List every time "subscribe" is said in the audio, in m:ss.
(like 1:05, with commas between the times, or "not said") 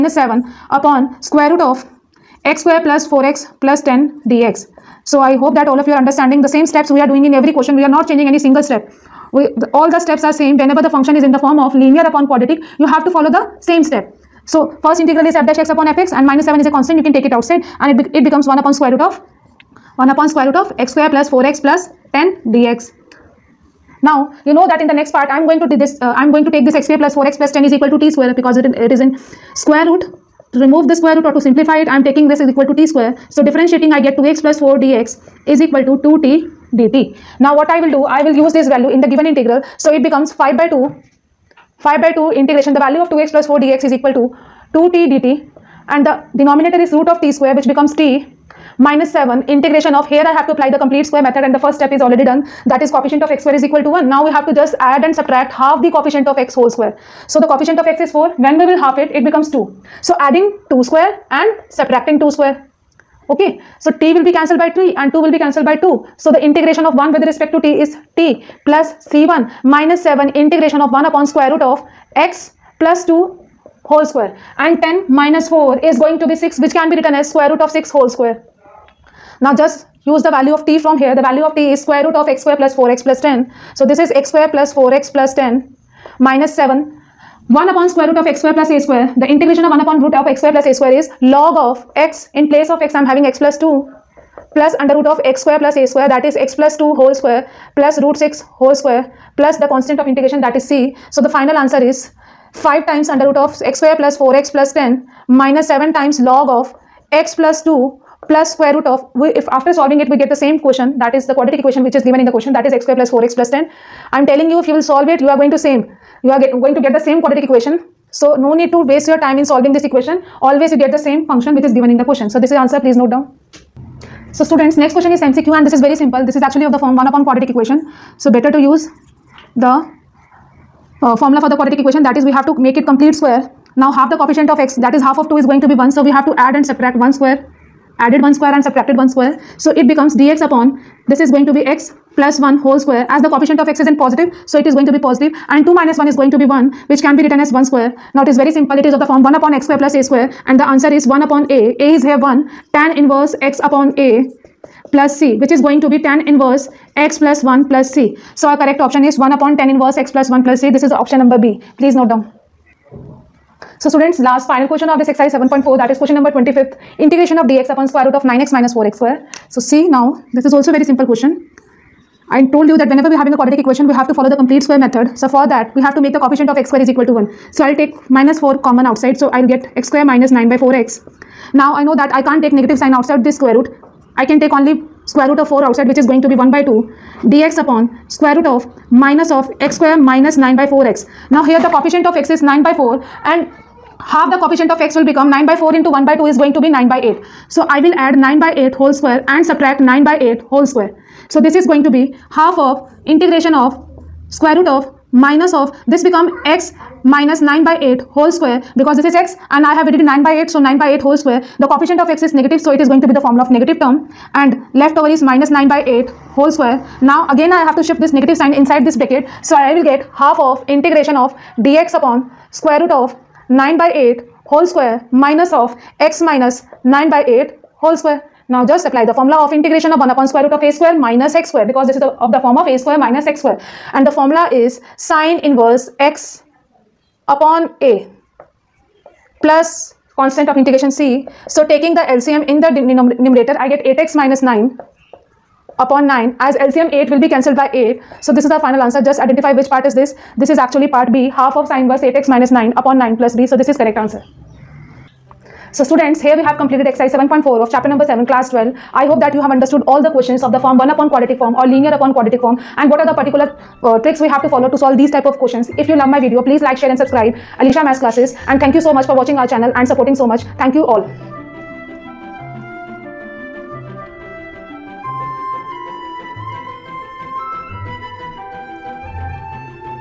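4:26.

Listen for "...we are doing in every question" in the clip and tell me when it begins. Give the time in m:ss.
0:06.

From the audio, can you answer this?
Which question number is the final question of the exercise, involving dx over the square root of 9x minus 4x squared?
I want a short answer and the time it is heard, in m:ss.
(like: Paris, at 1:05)
25, at 2:45.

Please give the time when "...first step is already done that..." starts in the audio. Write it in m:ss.
0:51.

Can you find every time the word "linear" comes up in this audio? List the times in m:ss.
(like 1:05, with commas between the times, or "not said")
0:11, 4:21.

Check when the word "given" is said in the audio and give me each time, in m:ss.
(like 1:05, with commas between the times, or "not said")
0:39, 1:52, 2:01.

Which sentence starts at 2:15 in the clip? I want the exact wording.
So we have to add and subtract 1 square added 1 square and subtracted 1 square.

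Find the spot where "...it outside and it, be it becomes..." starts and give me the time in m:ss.
0:17.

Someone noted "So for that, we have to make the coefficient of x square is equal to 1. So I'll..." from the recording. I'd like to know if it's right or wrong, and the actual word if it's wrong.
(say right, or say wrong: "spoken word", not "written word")
right.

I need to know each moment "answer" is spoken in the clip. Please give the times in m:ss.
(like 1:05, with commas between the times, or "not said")
1:41, 2:02, 2:30, 4:08, 4:13.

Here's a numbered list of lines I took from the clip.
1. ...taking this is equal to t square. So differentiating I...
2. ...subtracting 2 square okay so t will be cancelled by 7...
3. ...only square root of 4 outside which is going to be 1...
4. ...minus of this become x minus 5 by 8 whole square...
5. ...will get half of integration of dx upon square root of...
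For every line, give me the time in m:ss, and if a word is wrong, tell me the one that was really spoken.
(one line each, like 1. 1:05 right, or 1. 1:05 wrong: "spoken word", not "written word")
1. 0:32 right
2. 1:01 wrong: "3", not "7"
3. 3:04 right
4. 3:25 wrong: "9", not "5"
5. 3:39 right.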